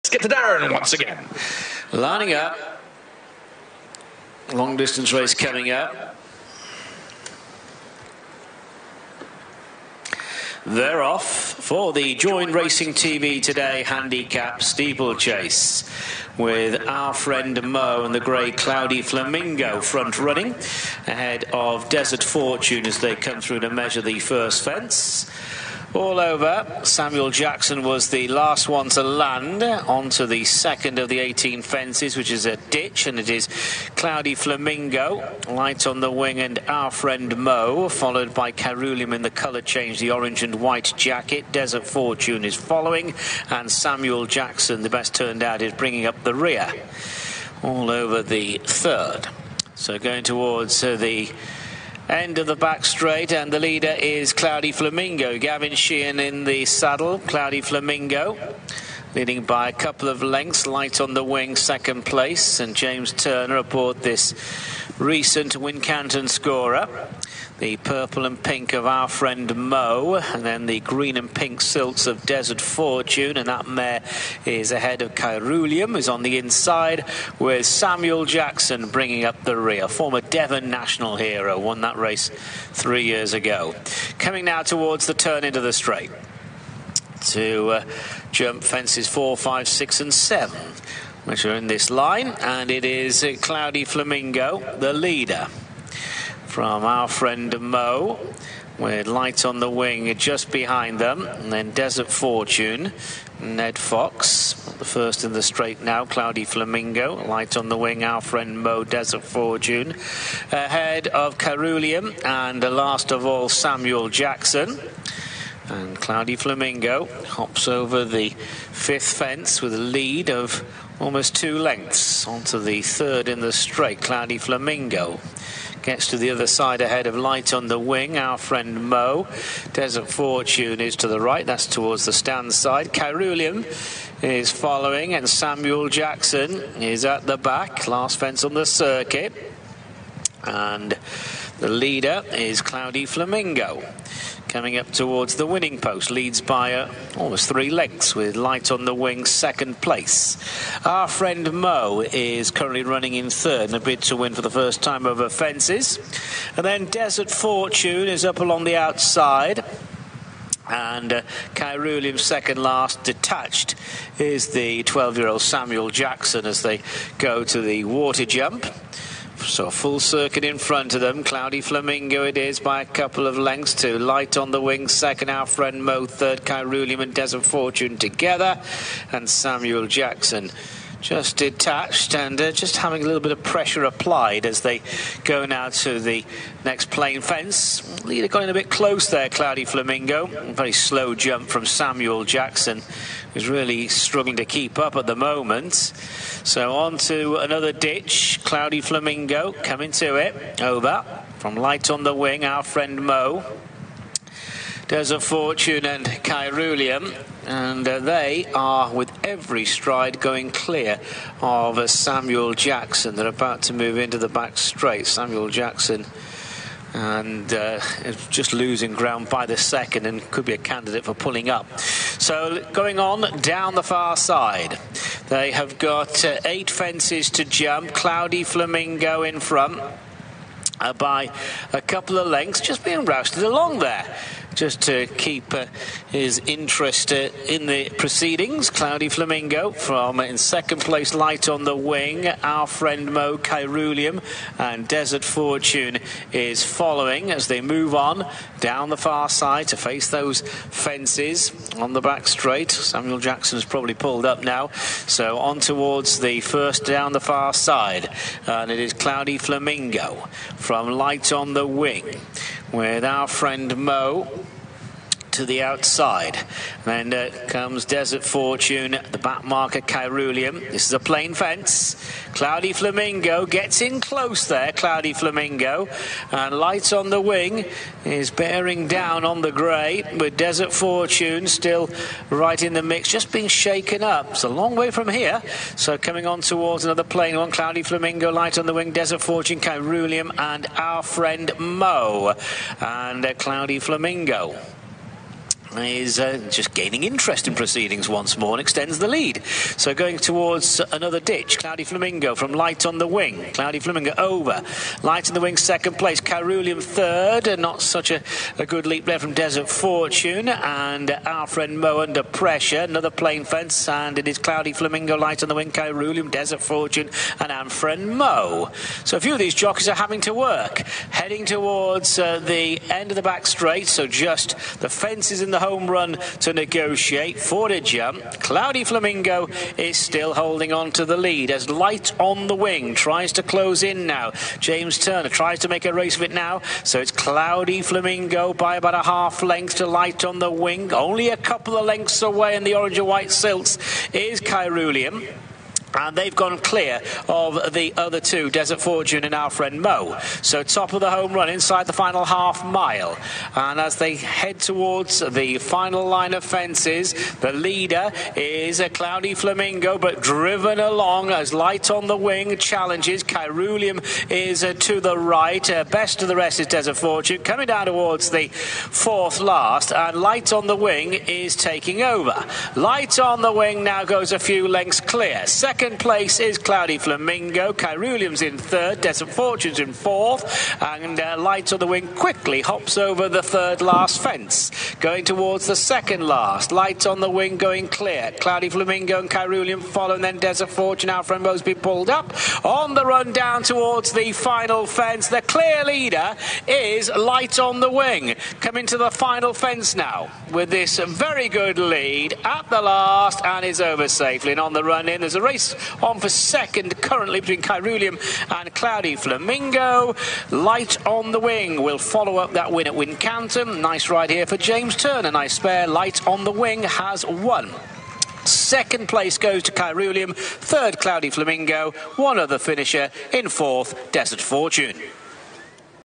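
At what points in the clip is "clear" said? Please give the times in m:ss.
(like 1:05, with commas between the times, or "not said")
3:30, 5:46, 6:14, 6:27, 6:35.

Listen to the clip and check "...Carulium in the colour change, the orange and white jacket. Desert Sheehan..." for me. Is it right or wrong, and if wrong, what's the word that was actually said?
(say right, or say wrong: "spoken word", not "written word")
wrong: "Fortune", not "Sheehan".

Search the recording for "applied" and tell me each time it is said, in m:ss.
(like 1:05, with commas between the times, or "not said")
3:03.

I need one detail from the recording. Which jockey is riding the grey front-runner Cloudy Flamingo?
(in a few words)
Gavin Sheehan.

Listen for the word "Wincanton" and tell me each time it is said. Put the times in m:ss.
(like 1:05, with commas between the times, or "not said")
1:05, 6:52.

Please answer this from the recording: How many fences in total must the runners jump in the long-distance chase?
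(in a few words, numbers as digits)
18.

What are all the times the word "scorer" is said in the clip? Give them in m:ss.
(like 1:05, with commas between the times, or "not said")
1:06.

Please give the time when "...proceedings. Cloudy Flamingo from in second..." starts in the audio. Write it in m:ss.
3:57.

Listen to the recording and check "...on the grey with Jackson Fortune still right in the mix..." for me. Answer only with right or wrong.
wrong.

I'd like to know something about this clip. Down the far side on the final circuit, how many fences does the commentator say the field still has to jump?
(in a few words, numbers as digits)
8.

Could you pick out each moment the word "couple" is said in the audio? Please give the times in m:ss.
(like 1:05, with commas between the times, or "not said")
0:59, 2:52, 3:51, 5:41.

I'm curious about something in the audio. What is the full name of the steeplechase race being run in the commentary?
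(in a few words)
Join Racing TV Today Handicap Steeplechase.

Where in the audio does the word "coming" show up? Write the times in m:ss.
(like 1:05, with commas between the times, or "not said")
0:05, 1:24, 2:24, 3:19, 4:45, 6:07, 6:38.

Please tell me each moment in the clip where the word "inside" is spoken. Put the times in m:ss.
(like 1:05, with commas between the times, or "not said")
1:16, 5:51.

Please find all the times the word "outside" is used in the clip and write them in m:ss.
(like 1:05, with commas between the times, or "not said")
2:38, 4:25.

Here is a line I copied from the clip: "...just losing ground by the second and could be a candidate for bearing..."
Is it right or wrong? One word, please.
wrong.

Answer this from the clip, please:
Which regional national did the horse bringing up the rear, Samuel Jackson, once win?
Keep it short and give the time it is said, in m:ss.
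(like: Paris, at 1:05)
Devon national, at 1:20.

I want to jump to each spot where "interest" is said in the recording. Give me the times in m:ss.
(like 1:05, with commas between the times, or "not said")
3:56, 4:57.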